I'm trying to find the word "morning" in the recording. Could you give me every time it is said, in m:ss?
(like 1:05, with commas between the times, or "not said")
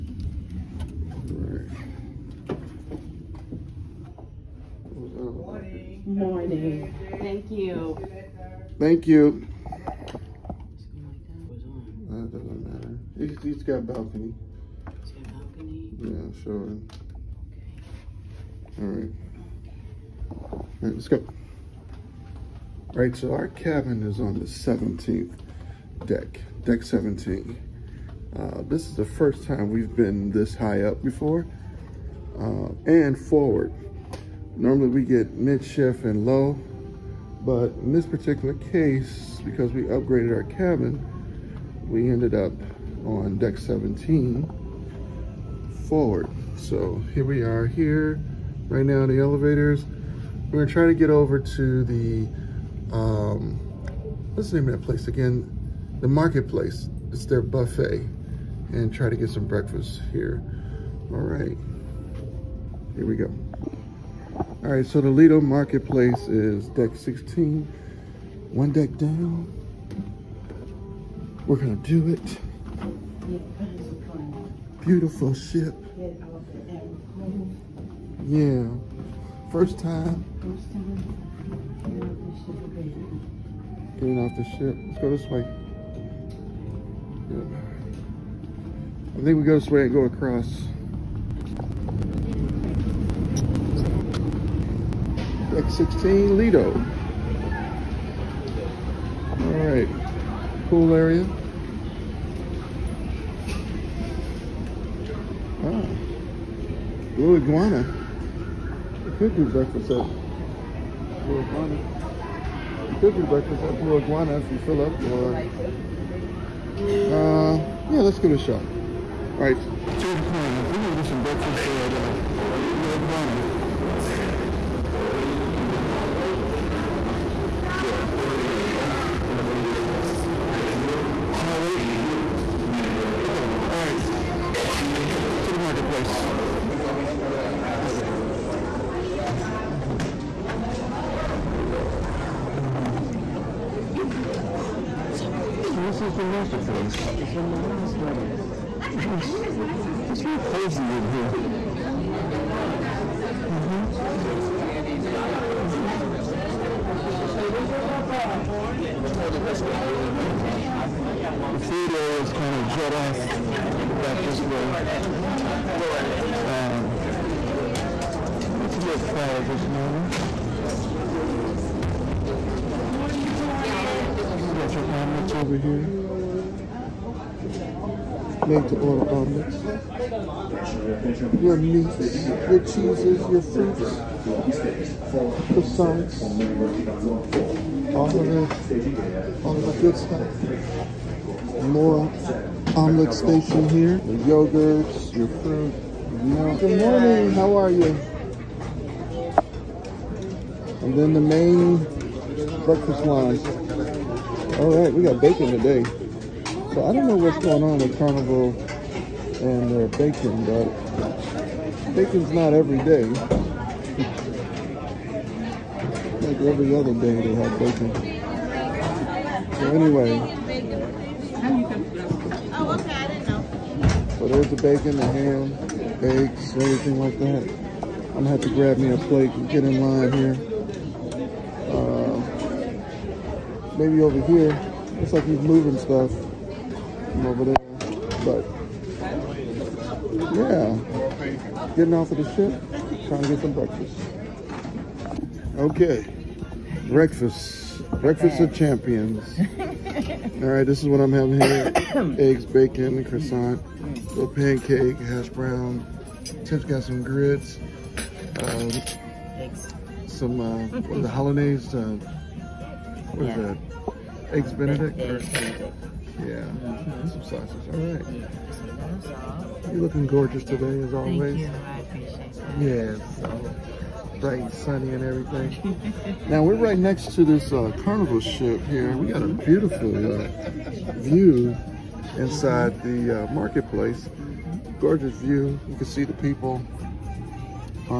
0:06, 2:49, 3:16.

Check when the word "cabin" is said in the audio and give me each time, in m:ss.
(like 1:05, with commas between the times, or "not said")
0:23, 0:40.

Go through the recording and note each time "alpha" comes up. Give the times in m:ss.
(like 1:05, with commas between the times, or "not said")
not said.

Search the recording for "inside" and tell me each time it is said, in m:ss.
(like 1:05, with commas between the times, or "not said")
4:42.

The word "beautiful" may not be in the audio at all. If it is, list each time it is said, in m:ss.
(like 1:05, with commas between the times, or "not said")
1:14, 4:39.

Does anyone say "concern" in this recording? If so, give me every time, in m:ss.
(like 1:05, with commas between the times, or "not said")
not said.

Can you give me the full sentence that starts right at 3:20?
And then the main breakfast line.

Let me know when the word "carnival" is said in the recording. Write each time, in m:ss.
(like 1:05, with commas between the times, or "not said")
3:27, 4:37.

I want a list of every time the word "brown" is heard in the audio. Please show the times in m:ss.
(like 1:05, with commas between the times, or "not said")
4:15.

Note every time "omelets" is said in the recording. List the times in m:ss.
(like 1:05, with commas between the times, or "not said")
2:54, 2:59, 3:12.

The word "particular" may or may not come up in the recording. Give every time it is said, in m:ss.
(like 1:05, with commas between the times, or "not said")
0:38.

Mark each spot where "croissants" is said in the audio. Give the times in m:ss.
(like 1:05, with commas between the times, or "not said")
3:05, 4:13.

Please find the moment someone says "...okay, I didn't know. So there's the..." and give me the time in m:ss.
3:42.